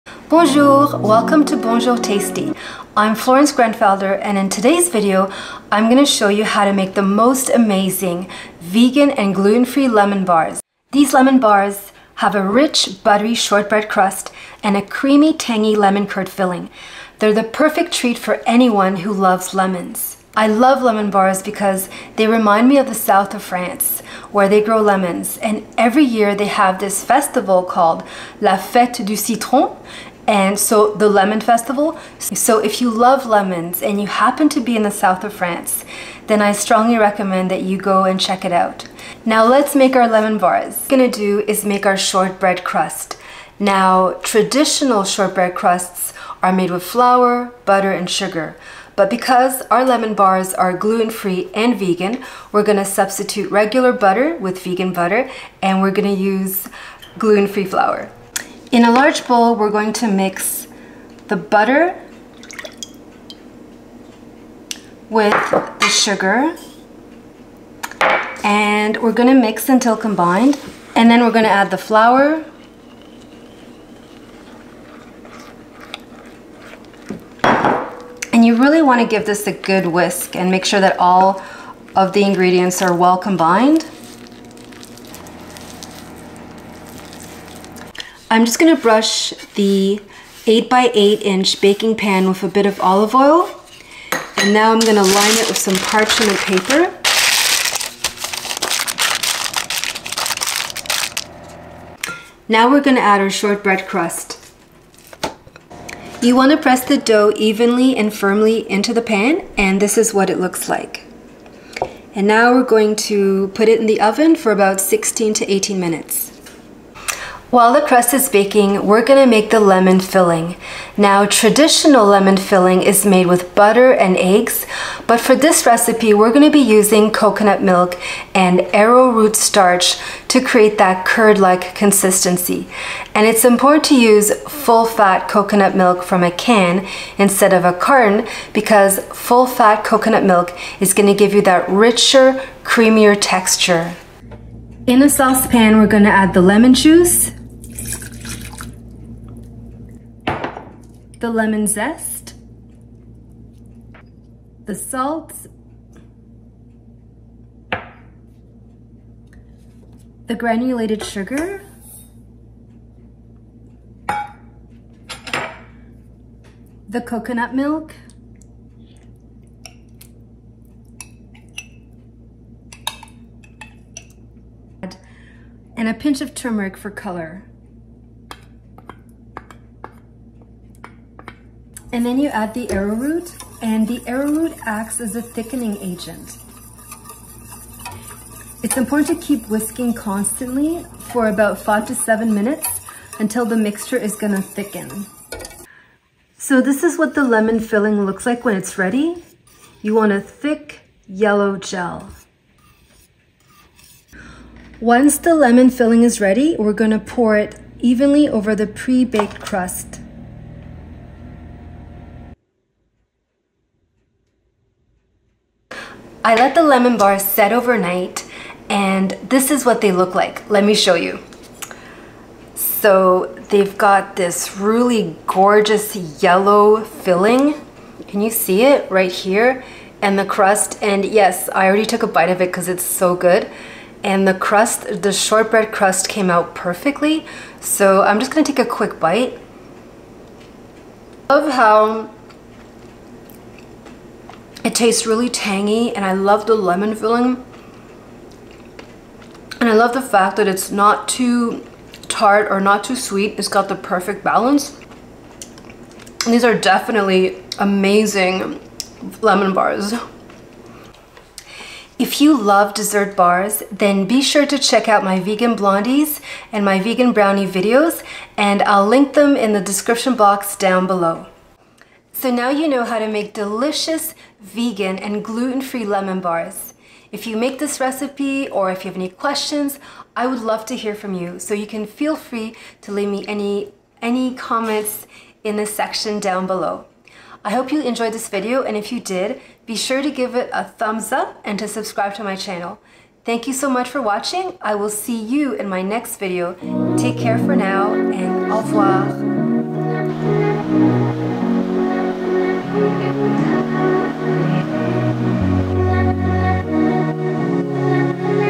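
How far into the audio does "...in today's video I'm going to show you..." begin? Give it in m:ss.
0:04.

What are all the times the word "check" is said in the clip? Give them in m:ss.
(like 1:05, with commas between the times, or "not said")
0:38, 4:24.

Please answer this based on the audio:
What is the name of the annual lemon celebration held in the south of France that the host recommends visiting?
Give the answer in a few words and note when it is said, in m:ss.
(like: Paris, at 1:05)
La Fête du Citron, at 0:28.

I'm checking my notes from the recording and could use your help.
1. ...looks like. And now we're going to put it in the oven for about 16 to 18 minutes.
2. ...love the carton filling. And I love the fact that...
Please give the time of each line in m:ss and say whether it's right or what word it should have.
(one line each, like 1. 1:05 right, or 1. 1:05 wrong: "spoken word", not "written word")
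1. 1:50 right
2. 4:06 wrong: "lemon", not "carton".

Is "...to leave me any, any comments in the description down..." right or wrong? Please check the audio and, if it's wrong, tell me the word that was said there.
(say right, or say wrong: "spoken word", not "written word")
wrong: "section", not "description".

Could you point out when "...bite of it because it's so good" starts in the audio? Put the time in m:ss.
3:52.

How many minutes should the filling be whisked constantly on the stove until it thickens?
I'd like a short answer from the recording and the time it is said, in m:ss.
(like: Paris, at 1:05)
5 to 7 minutes, at 3:11.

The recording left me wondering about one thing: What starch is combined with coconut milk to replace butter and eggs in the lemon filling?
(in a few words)
arrowroot starch.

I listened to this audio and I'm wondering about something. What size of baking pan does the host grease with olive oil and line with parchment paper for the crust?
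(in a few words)
8 by 8 inch.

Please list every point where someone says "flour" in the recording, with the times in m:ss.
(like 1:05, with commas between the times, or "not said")
0:46, 0:57, 1:11.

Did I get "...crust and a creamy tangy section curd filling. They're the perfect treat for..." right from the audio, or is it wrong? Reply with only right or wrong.
wrong.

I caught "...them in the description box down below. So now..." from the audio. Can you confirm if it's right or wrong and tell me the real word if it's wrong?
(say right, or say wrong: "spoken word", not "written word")
right.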